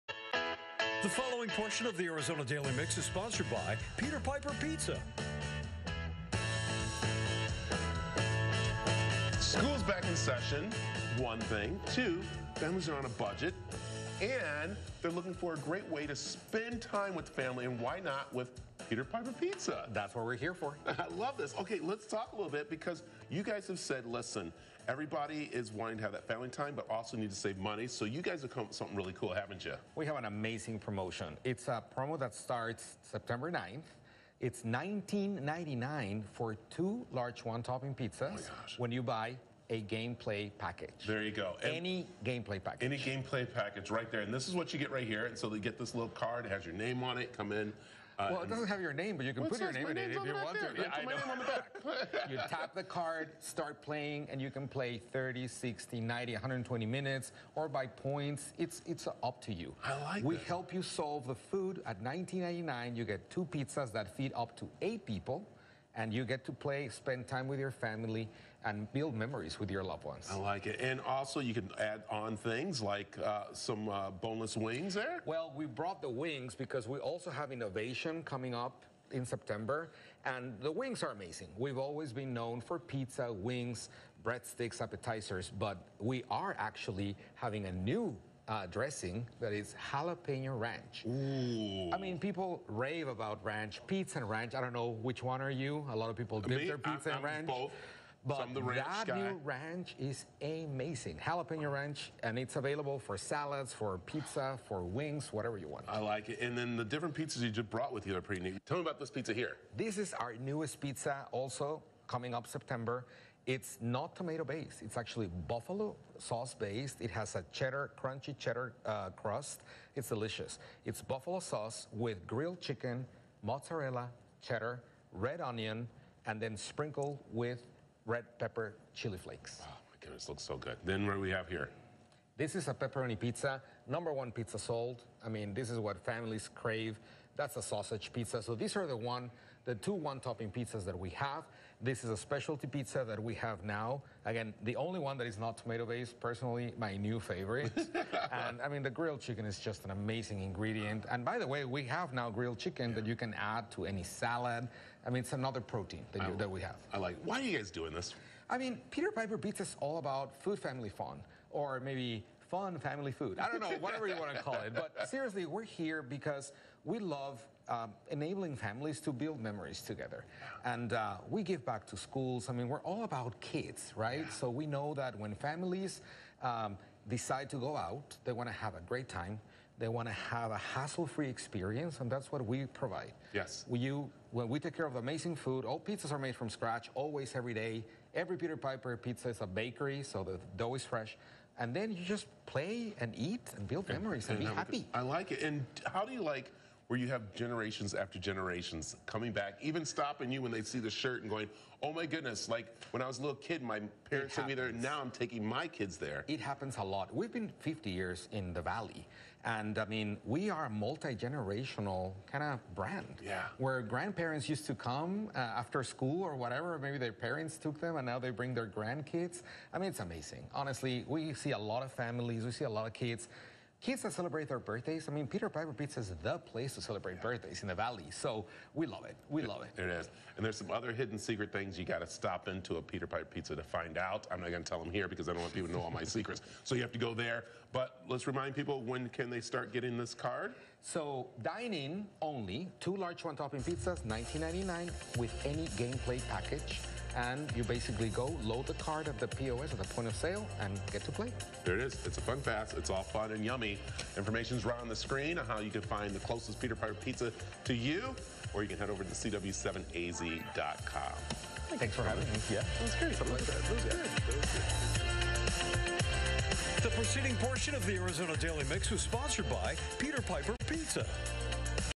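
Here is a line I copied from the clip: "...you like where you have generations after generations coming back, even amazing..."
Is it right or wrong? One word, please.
wrong.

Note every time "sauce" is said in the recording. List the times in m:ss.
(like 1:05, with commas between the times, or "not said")
1:56, 2:01.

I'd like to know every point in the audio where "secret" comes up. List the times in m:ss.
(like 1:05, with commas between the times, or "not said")
3:51, 3:56.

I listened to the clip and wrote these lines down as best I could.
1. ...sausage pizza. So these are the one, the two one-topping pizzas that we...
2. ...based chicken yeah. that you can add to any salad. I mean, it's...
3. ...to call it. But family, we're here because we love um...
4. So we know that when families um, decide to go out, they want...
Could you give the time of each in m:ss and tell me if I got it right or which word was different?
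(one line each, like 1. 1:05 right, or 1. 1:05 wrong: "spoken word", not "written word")
1. 2:17 right
2. 2:32 wrong: "grilled", not "based"
3. 2:44 wrong: "seriously", not "family"
4. 2:54 right.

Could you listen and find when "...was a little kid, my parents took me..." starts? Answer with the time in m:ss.
3:23.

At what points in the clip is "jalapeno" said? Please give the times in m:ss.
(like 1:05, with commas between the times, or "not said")
1:29, 1:41.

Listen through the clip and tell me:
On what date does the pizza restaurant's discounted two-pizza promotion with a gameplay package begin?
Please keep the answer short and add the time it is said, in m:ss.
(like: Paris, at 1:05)
September 9th, at 0:33.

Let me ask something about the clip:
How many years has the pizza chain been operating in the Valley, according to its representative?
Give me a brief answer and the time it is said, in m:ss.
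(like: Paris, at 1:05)
50 years, at 3:27.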